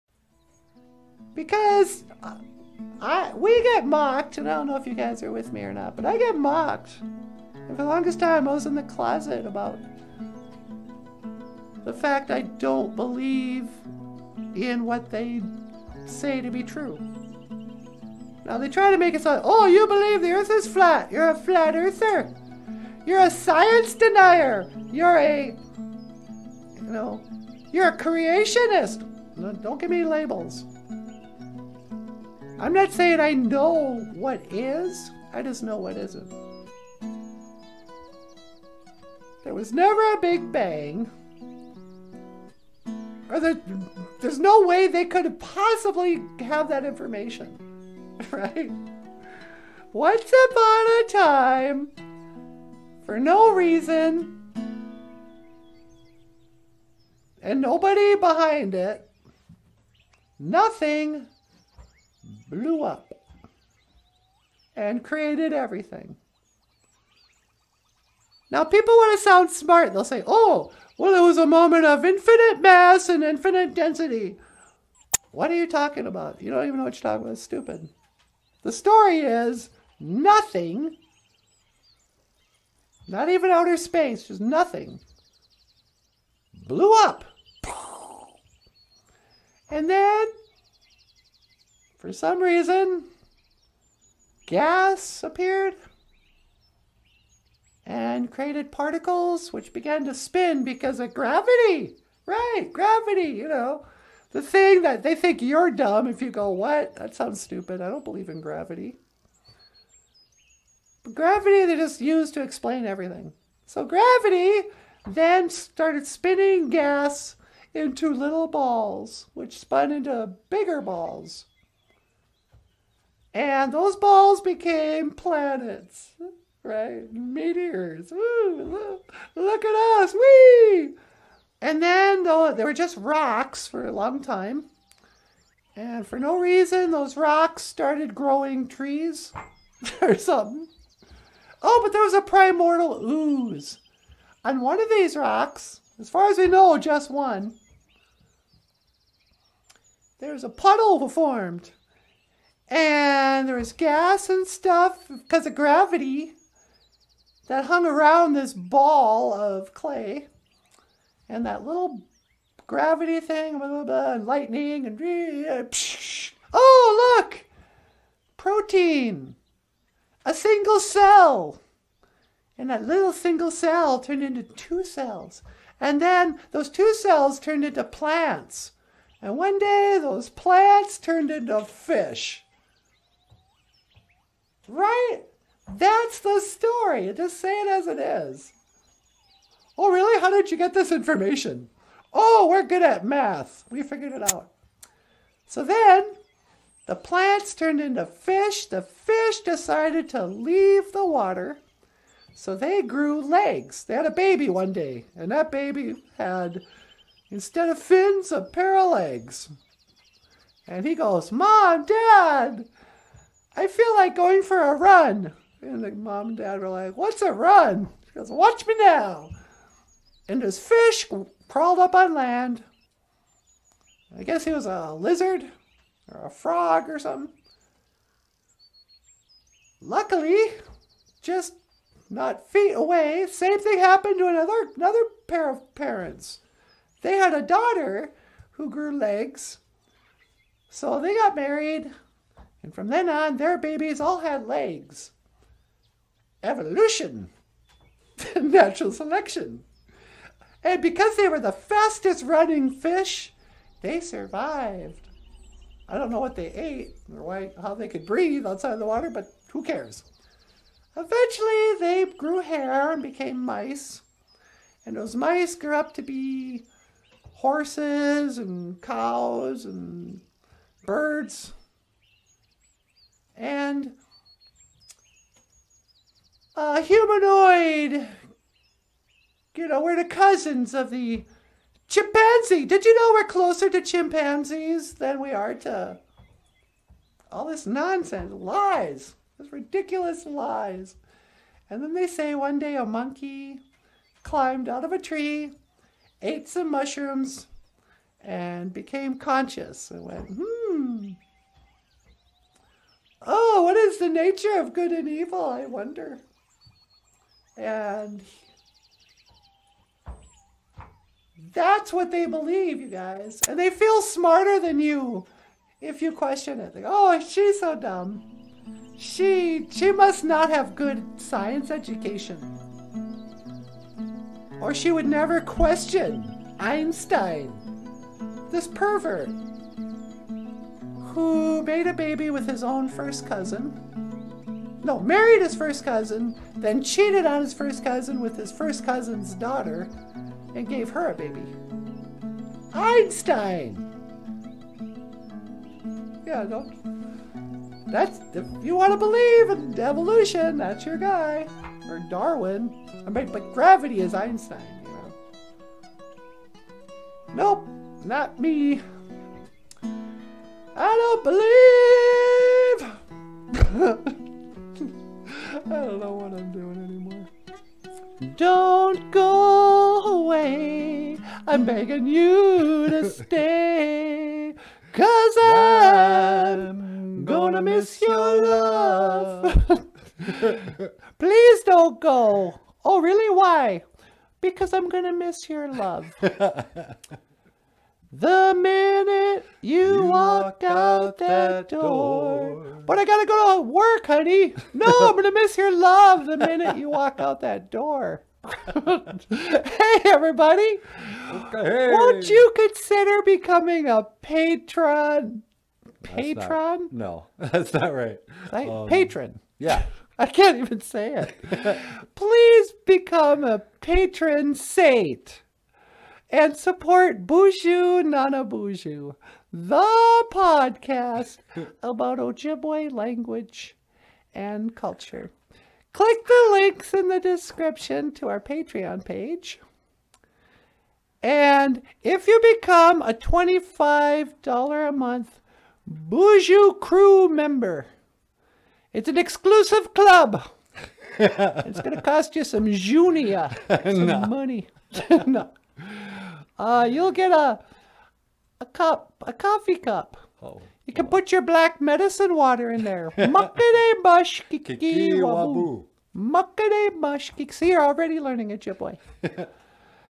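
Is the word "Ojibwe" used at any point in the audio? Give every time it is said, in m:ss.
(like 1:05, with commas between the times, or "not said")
7:02, 7:38.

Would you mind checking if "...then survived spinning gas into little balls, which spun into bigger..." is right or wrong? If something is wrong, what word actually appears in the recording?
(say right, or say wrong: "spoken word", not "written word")
wrong: "started", not "survived".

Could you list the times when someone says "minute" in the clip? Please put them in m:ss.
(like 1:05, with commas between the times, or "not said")
6:28, 6:36.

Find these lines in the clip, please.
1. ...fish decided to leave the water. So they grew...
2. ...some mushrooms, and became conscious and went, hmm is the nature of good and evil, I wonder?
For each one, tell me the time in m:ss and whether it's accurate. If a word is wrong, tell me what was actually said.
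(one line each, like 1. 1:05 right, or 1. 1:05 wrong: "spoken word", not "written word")
1. 3:18 right
2. 4:56 right.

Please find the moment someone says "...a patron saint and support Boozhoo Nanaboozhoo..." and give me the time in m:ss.
6:53.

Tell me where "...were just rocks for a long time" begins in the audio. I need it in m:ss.
2:12.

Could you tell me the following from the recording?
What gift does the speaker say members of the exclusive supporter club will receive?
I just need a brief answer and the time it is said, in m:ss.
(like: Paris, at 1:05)
a coffee cup, at 7:29.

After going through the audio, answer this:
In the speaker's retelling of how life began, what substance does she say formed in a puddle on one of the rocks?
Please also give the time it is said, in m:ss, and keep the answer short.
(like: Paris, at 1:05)
primordial ooze, at 2:22.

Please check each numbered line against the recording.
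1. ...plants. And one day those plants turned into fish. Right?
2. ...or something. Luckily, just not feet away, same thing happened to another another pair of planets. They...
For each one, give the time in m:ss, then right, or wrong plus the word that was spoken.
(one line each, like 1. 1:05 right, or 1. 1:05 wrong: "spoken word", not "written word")
1. 2:57 right
2. 3:46 wrong: "parents", not "planets".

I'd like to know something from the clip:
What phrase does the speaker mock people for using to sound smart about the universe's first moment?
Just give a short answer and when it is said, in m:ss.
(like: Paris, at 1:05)
infinite mass and infinite density, at 1:12.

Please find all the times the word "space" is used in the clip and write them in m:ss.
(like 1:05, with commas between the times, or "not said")
1:23.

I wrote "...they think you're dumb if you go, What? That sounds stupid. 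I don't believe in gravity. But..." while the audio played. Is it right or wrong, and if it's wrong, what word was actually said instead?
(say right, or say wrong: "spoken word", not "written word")
right.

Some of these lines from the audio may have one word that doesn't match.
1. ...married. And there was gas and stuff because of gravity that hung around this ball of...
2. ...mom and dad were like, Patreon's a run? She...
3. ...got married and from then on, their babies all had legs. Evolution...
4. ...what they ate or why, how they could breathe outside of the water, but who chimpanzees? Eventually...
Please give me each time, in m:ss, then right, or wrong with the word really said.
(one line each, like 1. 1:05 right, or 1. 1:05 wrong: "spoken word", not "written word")
1. 2:31 wrong: "formed", not "married"
2. 3:35 wrong: "What", not "Patreon"
3. 4:01 right
4. 4:16 wrong: "cares", not "chimpanzees".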